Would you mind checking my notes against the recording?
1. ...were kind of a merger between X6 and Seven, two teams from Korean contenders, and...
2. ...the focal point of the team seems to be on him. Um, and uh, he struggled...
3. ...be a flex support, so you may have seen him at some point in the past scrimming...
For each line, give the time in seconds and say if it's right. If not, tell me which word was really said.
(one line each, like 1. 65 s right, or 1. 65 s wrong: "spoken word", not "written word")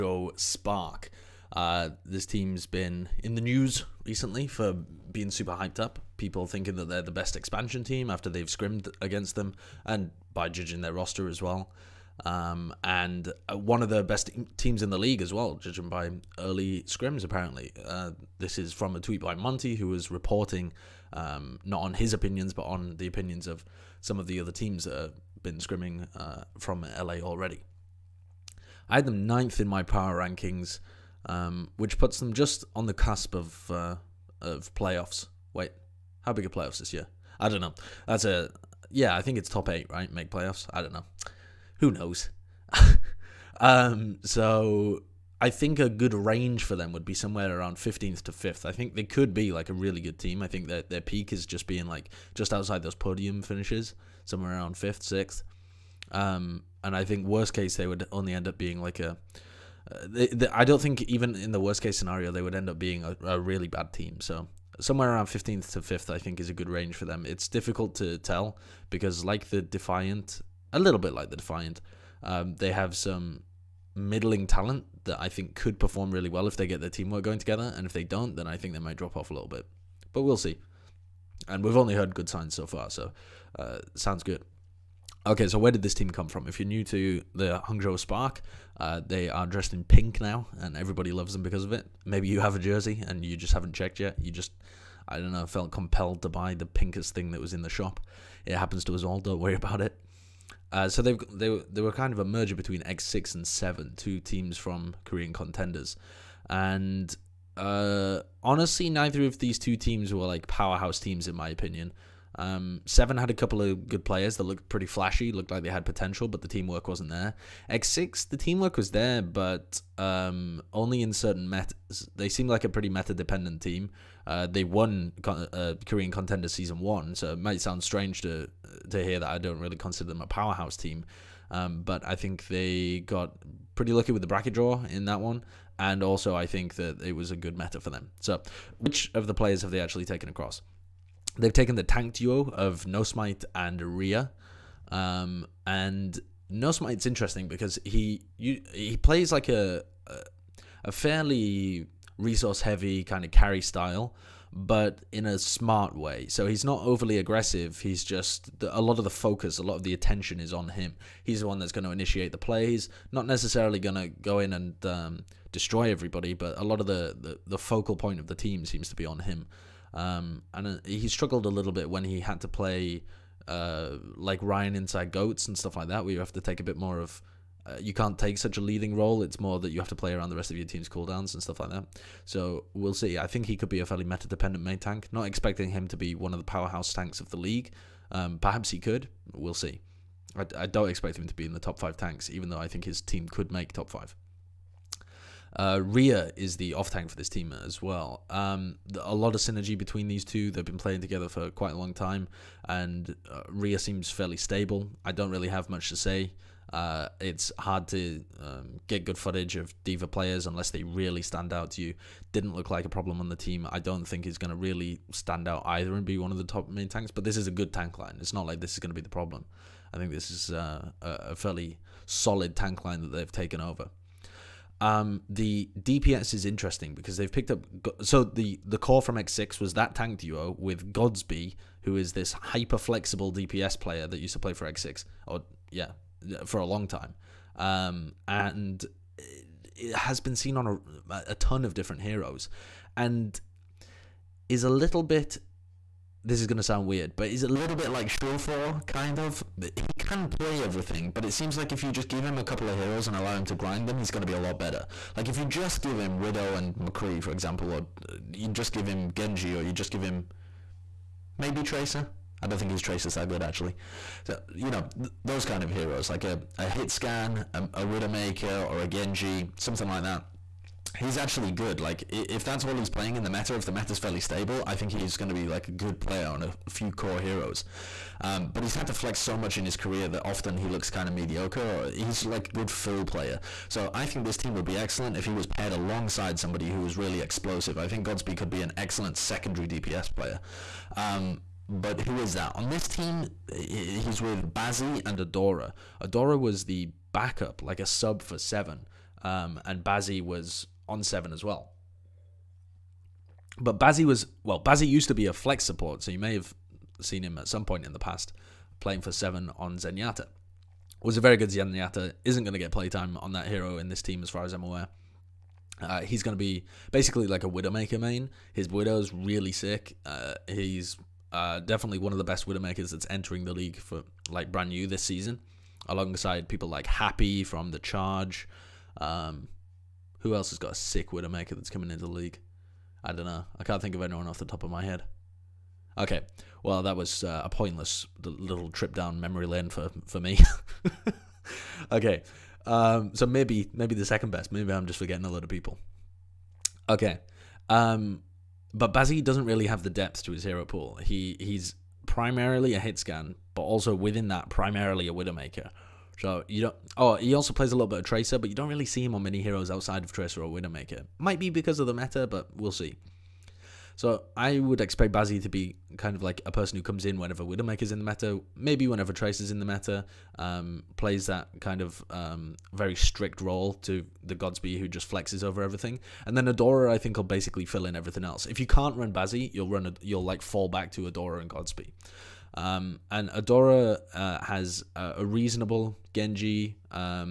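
1. 101 s right
2. 167 s right
3. 305 s wrong: "playing", not "scrimming".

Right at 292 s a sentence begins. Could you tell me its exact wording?
On this team, he's with Bazzi and Adora.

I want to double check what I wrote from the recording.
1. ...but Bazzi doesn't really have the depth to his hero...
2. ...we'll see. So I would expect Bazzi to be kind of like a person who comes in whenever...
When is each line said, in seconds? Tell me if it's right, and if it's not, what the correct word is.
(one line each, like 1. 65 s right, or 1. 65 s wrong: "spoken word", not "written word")
1. 348 s right
2. 362 s right.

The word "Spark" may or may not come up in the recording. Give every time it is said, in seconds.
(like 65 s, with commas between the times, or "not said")
0 s, 87 s.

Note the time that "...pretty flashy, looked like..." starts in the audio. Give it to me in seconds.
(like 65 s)
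114 s.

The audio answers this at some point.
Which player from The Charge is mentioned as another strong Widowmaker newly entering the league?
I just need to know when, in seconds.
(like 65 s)
326 s.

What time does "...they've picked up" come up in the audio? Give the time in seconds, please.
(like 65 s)
227 s.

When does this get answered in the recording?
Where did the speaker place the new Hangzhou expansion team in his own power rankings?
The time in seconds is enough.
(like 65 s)
29 s.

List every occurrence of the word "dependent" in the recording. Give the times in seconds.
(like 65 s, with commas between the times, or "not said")
123 s, 184 s.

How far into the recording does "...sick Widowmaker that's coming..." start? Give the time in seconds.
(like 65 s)
330 s.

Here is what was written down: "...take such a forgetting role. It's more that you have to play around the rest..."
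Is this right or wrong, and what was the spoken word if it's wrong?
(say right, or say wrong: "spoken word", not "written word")
wrong: "leading", not "forgetting".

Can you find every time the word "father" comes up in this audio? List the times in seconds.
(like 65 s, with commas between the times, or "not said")
not said.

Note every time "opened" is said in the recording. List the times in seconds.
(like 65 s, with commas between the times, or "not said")
not said.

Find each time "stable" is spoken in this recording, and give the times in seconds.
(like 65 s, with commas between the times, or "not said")
204 s, 274 s.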